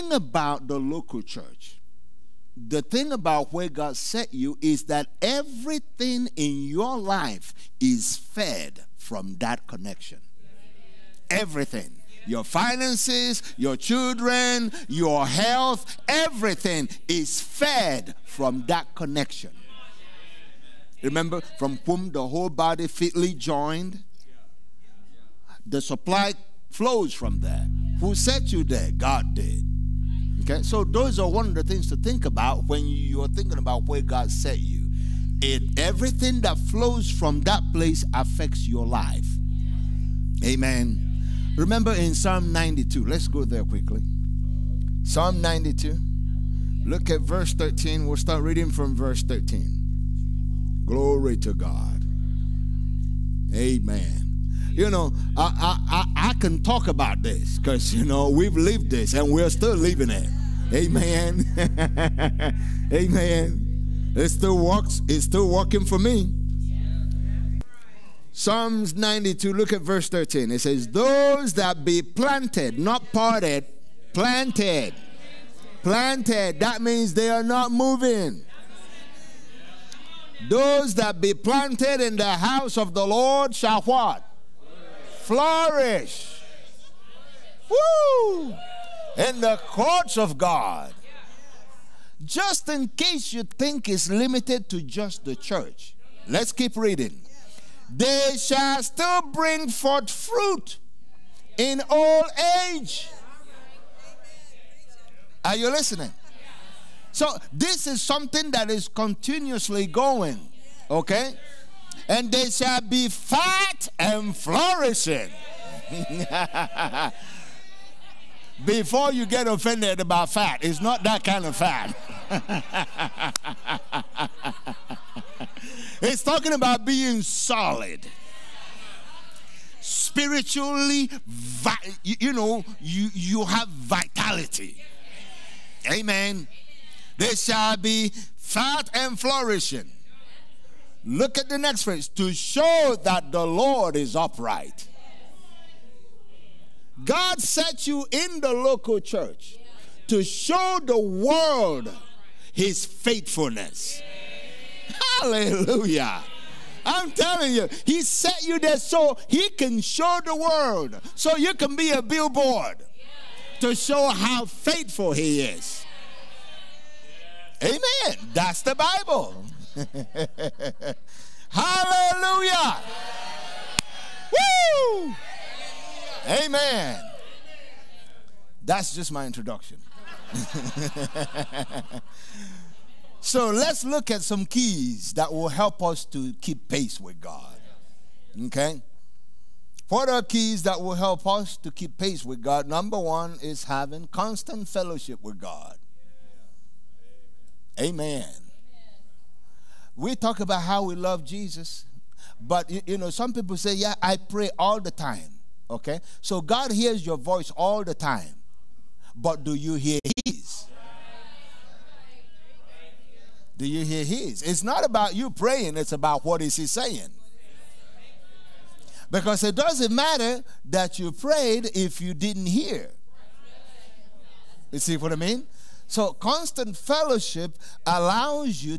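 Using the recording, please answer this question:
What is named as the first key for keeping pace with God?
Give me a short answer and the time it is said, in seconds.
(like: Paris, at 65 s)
constant fellowship with God, at 194 s.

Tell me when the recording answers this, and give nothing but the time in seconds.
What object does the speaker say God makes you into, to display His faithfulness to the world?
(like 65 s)
162 s.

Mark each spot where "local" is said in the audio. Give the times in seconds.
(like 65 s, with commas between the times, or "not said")
0 s, 148 s.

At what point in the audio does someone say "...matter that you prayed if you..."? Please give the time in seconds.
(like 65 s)
219 s.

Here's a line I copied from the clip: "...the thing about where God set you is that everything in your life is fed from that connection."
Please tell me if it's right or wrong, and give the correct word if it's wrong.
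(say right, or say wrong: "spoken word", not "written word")
right.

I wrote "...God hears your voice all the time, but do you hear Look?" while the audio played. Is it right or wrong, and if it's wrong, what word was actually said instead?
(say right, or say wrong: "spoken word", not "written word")
wrong: "His", not "Look".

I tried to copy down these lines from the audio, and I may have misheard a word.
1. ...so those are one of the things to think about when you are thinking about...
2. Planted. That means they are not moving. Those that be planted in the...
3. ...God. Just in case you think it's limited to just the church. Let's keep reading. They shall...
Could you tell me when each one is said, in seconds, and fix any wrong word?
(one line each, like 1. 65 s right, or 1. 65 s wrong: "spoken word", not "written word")
1. 30 s right
2. 75 s right
3. 90 s right.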